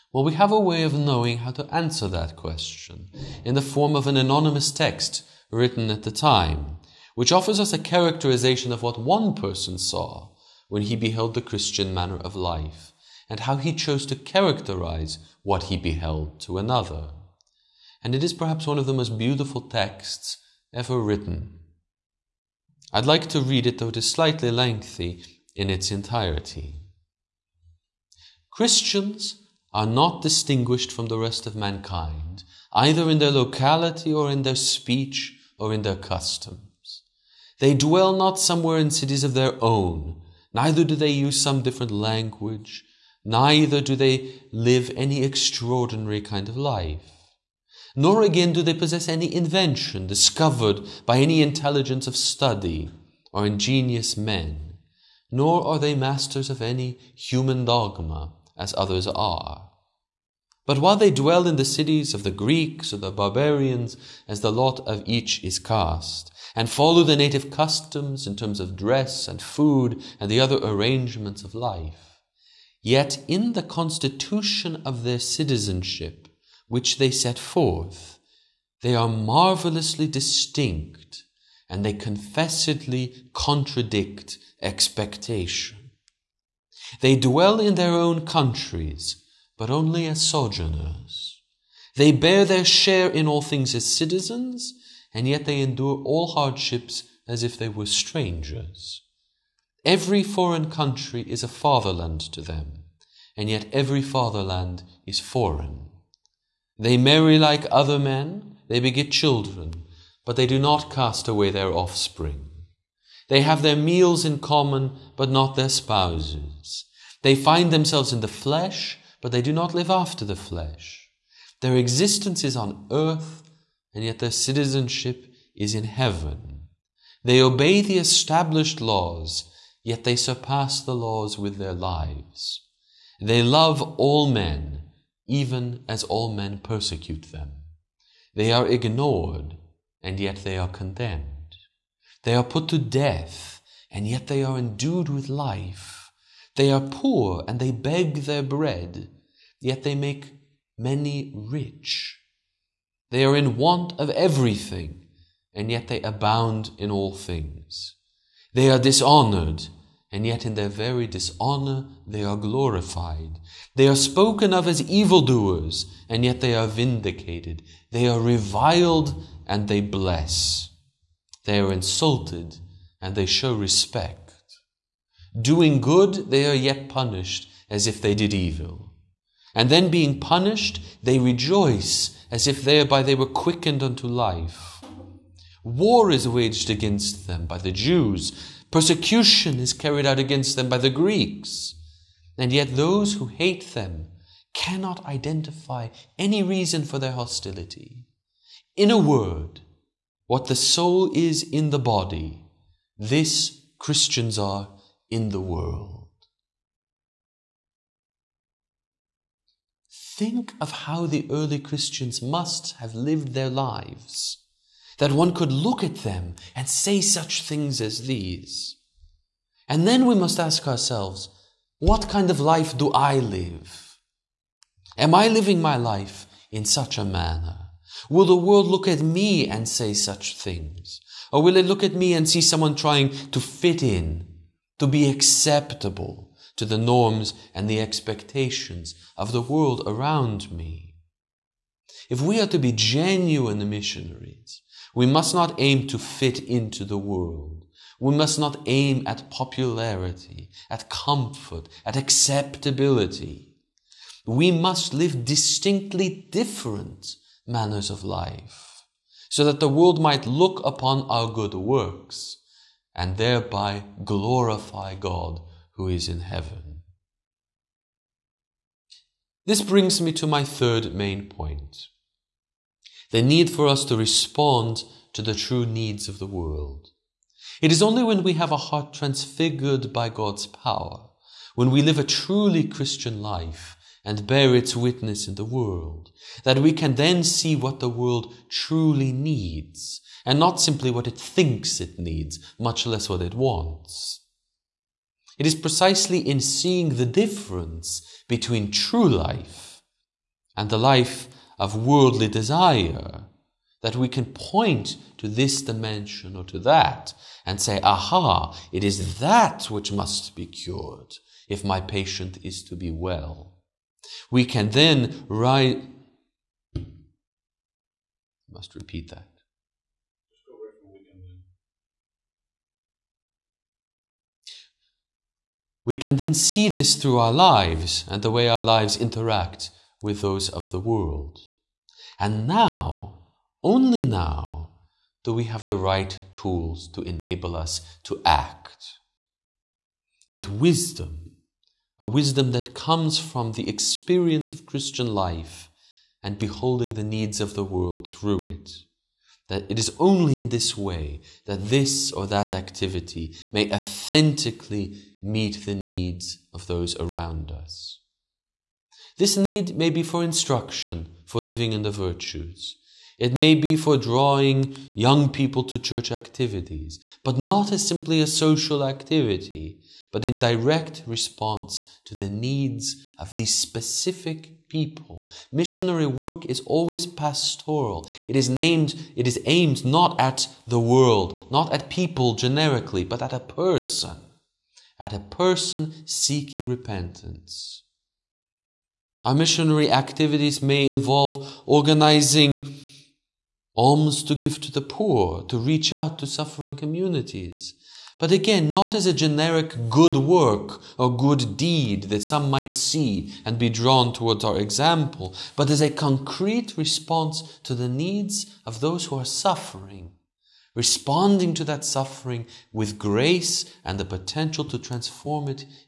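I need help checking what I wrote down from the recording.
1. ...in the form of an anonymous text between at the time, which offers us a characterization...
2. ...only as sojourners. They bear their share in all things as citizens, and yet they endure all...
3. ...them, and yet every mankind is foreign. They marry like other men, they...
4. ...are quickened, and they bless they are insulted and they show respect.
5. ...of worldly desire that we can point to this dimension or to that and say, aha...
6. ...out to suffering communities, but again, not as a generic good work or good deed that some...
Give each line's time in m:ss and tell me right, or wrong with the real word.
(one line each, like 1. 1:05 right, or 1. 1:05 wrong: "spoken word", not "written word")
1. 0:03 wrong: "written", not "between"
2. 1:29 right
3. 1:42 wrong: "fatherland", not "mankind"
4. 2:48 wrong: "reviled", not "quickened"
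5. 5:01 right
6. 6:35 right.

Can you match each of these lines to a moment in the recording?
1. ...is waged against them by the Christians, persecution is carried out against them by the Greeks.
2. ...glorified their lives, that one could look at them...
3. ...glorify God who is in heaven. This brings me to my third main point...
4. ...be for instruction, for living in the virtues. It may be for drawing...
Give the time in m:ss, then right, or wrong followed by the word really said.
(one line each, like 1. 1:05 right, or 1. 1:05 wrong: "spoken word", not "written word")
1. 3:06 wrong: "Jews", not "Christians"
2. 3:32 wrong: "lived", not "glorified"
3. 4:24 right
4. 5:59 right.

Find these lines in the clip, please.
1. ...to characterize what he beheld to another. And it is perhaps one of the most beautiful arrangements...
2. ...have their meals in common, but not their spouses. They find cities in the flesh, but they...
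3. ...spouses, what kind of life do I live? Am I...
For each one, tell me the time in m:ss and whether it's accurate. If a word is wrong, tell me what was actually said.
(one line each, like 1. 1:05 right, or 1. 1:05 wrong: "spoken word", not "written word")
1. 0:14 wrong: "texts", not "arrangements"
2. 1:53 wrong: "themselves", not "cities"
3. 3:40 wrong: "ourselves", not "spouses".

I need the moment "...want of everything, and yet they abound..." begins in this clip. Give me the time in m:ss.
2:33.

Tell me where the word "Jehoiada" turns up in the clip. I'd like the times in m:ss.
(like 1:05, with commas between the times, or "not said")
not said.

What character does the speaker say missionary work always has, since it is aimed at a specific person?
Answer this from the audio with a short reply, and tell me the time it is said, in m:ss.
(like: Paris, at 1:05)
Pastoral, at 6:17.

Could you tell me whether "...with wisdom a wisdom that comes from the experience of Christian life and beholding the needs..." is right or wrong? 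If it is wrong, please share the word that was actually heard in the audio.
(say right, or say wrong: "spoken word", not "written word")
right.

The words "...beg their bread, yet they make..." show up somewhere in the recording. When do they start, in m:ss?
2:27.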